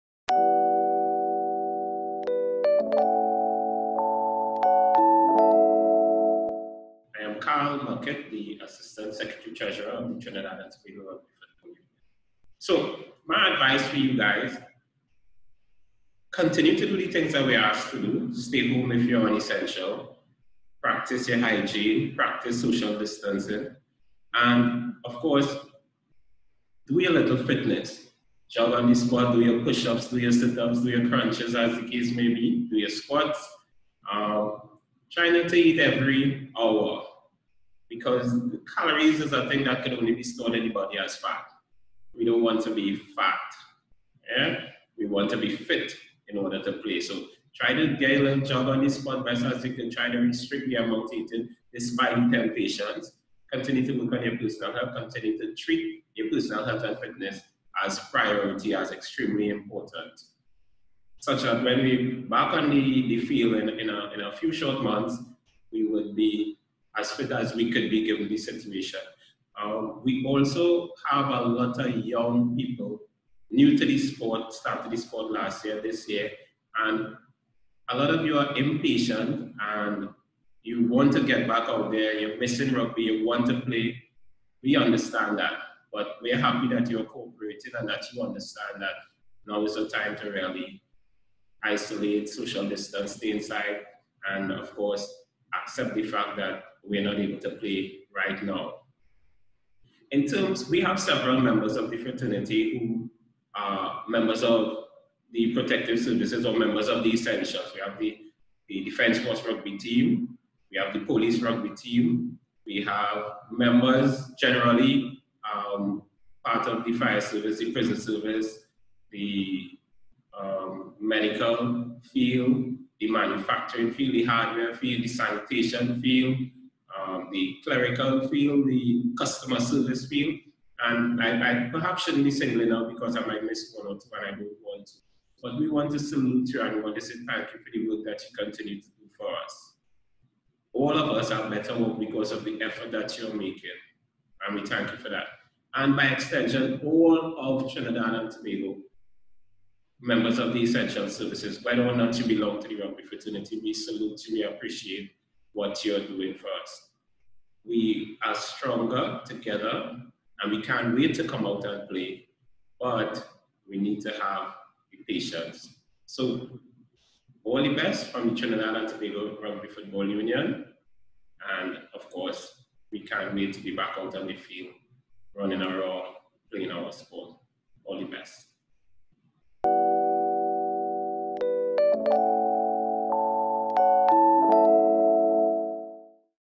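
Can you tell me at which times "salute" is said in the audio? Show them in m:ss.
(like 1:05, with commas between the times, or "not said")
2:15, 2:33.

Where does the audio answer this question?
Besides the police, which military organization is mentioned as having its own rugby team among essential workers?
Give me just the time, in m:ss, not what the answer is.
1:48.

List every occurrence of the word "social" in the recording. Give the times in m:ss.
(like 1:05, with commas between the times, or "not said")
0:22, 1:32.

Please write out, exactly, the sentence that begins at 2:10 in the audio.
And I, I perhaps shouldn't be singling out because I might miss one or two and I don't want to.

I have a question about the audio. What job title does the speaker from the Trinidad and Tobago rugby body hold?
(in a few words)
Assistant Secretary Treasurer.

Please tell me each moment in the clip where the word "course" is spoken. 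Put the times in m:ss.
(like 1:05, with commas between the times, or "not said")
0:25, 1:34, 2:52.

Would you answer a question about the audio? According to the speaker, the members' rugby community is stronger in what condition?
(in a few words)
Together.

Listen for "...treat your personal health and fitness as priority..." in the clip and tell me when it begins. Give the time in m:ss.
0:55.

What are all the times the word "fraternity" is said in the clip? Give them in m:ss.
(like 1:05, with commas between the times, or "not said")
1:41, 2:33.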